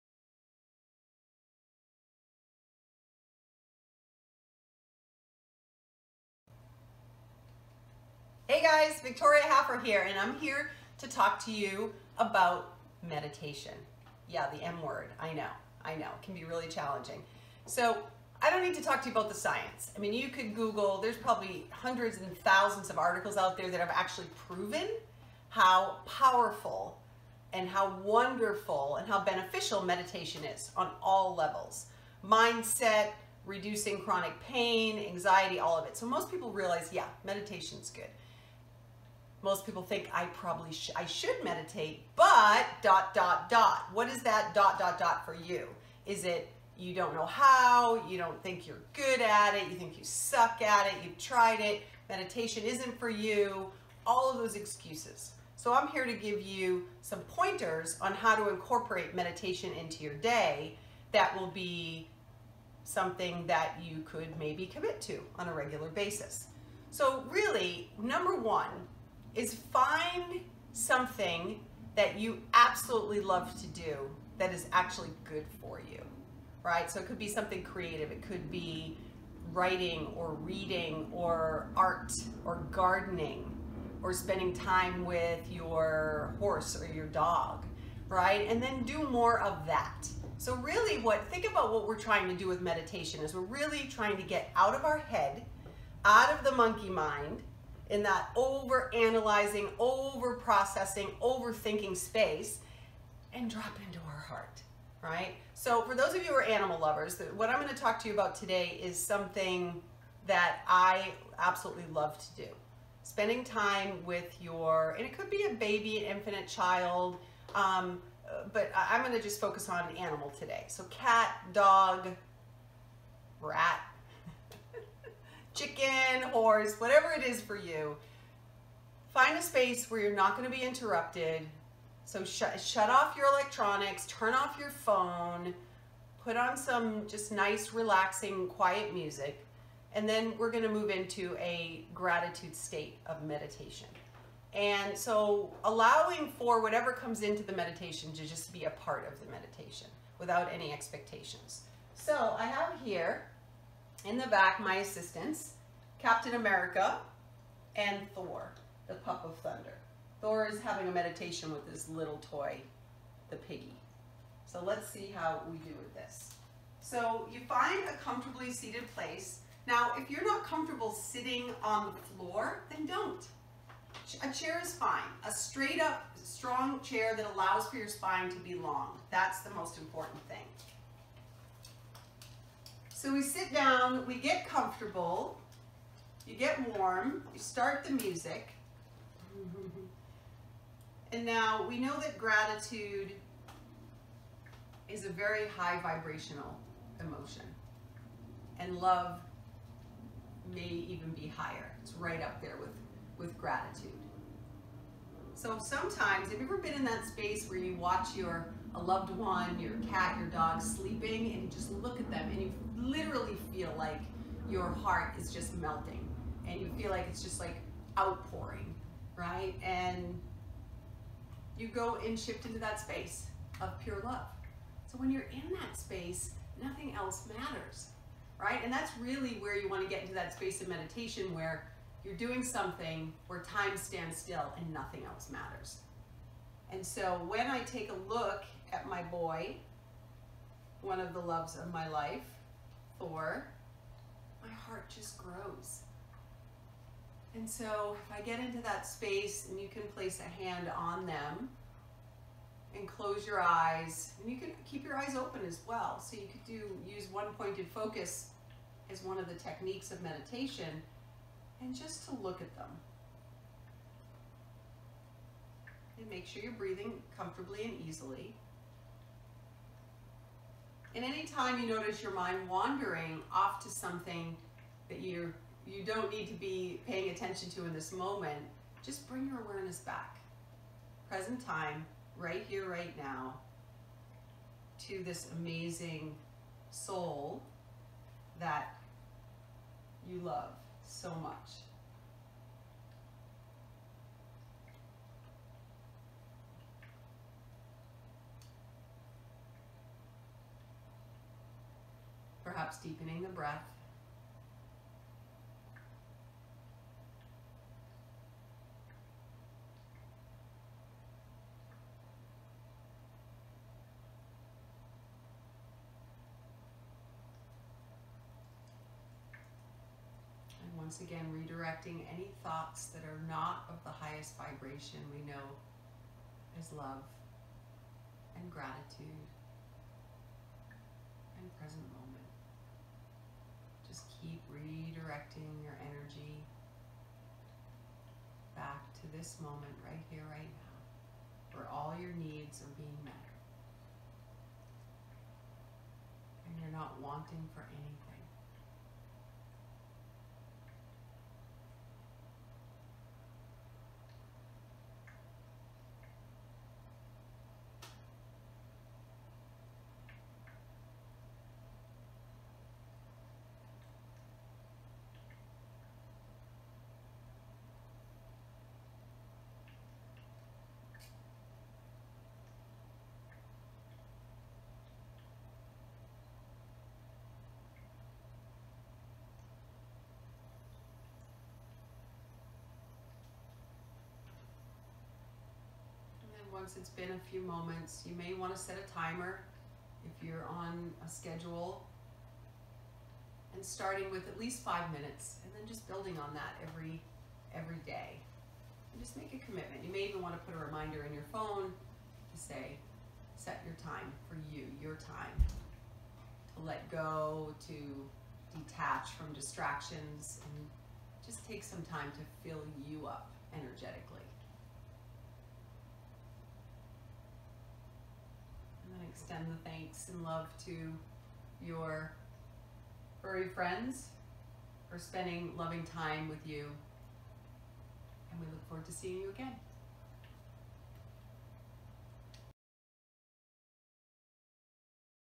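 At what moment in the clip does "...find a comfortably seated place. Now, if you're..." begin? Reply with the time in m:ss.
2:47.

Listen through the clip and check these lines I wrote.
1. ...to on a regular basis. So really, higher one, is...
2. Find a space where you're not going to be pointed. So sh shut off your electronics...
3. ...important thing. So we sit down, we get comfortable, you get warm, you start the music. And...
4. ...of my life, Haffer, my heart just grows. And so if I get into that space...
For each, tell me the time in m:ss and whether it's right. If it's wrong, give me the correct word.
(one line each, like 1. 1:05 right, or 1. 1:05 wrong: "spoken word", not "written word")
1. 1:05 wrong: "number", not "higher"
2. 2:09 wrong: "interrupted", not "pointed"
3. 2:59 right
4. 4:01 wrong: "Thor", not "Haffer".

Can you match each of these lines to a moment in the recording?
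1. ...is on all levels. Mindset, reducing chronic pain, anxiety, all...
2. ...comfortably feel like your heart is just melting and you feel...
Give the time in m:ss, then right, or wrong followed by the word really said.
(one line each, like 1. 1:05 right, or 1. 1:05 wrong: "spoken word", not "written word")
1. 0:30 right
2. 3:32 wrong: "literally", not "comfortably".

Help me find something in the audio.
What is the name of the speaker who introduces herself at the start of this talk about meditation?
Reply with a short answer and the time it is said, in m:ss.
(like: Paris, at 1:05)
Victoria Haffer, at 0:09.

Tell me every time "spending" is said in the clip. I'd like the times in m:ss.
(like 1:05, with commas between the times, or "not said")
1:24, 1:53, 7:04.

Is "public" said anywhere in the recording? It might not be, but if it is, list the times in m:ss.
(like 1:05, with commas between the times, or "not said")
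not said.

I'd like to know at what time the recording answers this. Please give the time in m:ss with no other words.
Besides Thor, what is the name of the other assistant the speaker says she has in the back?
2:36.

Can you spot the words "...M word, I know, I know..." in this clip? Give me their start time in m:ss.
0:14.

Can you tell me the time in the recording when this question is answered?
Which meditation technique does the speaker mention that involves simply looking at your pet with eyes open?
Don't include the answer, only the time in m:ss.
4:17.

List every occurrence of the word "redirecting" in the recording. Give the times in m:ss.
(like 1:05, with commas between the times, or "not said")
5:21, 5:34.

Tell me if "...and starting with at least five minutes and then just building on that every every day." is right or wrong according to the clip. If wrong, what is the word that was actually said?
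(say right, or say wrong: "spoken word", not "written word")
right.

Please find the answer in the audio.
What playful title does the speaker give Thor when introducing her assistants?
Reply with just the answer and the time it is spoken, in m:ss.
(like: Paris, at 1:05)
The pup of thunder, at 2:38.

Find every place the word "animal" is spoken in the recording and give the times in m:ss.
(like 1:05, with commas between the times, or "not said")
1:46, 1:59.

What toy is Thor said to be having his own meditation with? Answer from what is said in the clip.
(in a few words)
The piggy.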